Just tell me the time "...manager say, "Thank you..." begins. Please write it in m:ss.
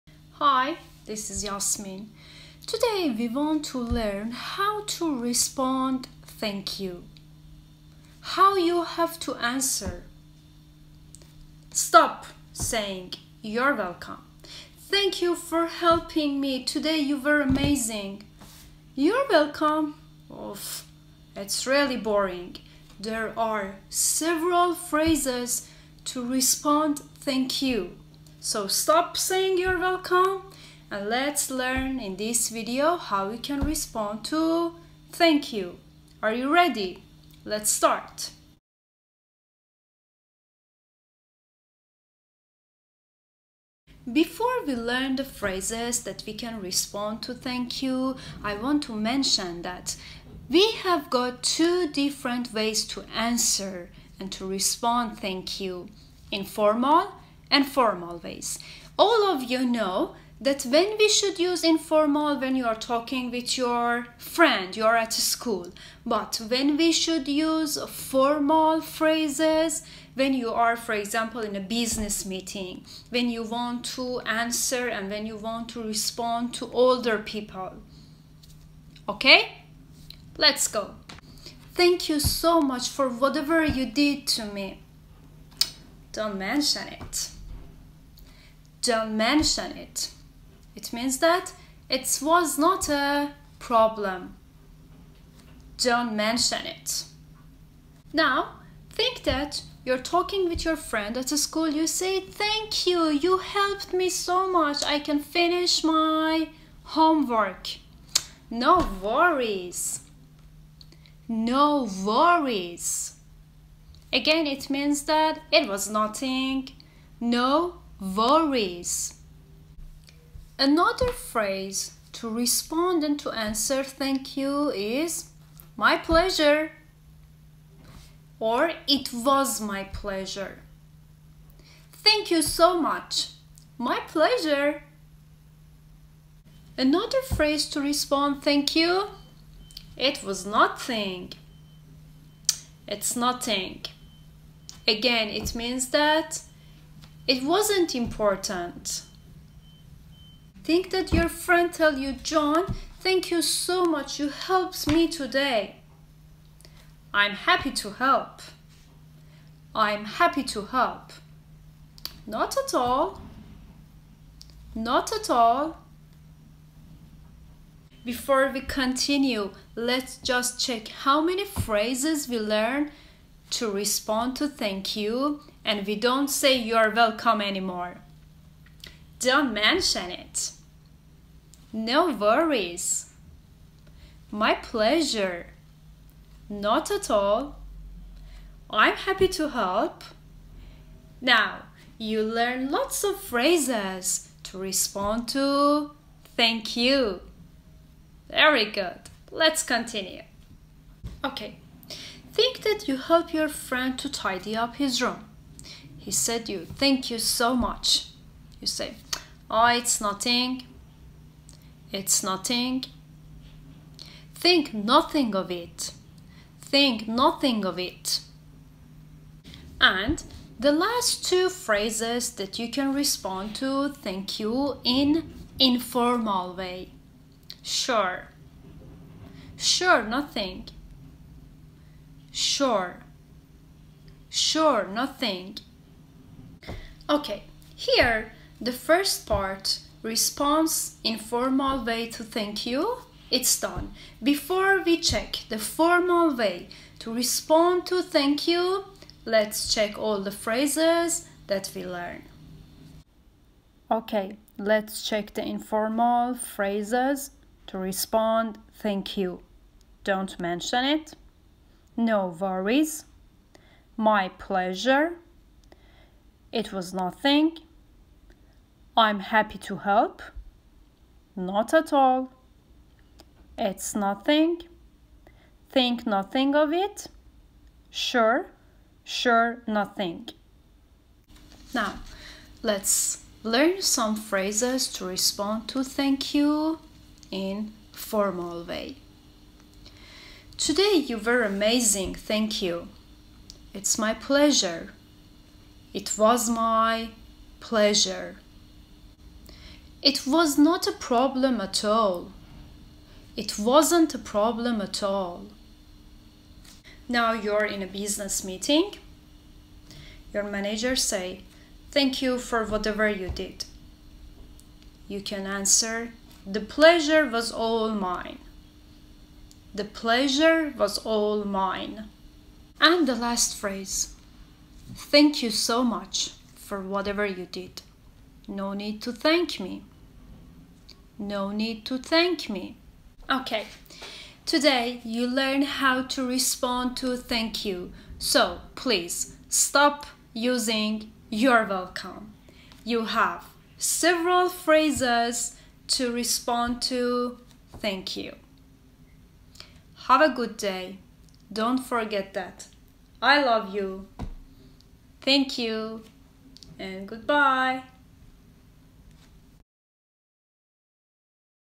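5:10.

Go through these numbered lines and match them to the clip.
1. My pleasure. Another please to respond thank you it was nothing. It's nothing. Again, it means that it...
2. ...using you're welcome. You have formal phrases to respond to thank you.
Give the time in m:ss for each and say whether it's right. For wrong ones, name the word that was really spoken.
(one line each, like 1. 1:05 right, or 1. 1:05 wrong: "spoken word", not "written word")
1. 2:13 wrong: "phrase", not "please"
2. 5:40 wrong: "several", not "formal".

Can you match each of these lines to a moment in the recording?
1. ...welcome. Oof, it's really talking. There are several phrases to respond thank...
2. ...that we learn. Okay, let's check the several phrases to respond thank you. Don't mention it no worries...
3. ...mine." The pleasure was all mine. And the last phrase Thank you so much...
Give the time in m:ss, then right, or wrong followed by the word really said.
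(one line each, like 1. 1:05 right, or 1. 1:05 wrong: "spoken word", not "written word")
1. 0:19 wrong: "boring", not "talking"
2. 4:11 wrong: "informal", not "several"
3. 5:18 right.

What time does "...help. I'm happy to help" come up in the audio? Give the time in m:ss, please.
2:37.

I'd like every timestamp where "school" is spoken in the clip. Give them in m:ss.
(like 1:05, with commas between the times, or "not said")
1:05, 1:41.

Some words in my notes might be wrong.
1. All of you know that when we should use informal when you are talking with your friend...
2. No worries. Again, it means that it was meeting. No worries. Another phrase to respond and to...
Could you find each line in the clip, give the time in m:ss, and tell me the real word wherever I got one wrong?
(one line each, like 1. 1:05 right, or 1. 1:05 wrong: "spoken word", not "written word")
1. 0:58 right
2. 1:51 wrong: "nothing", not "meeting".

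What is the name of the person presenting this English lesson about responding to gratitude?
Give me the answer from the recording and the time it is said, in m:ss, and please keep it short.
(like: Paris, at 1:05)
Yasmin, at 0:01.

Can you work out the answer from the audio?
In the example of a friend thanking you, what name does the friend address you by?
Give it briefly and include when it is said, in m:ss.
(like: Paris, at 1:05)
John, at 2:32.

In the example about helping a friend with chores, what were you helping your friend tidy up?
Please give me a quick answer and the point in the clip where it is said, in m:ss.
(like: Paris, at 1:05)
his room, at 3:24.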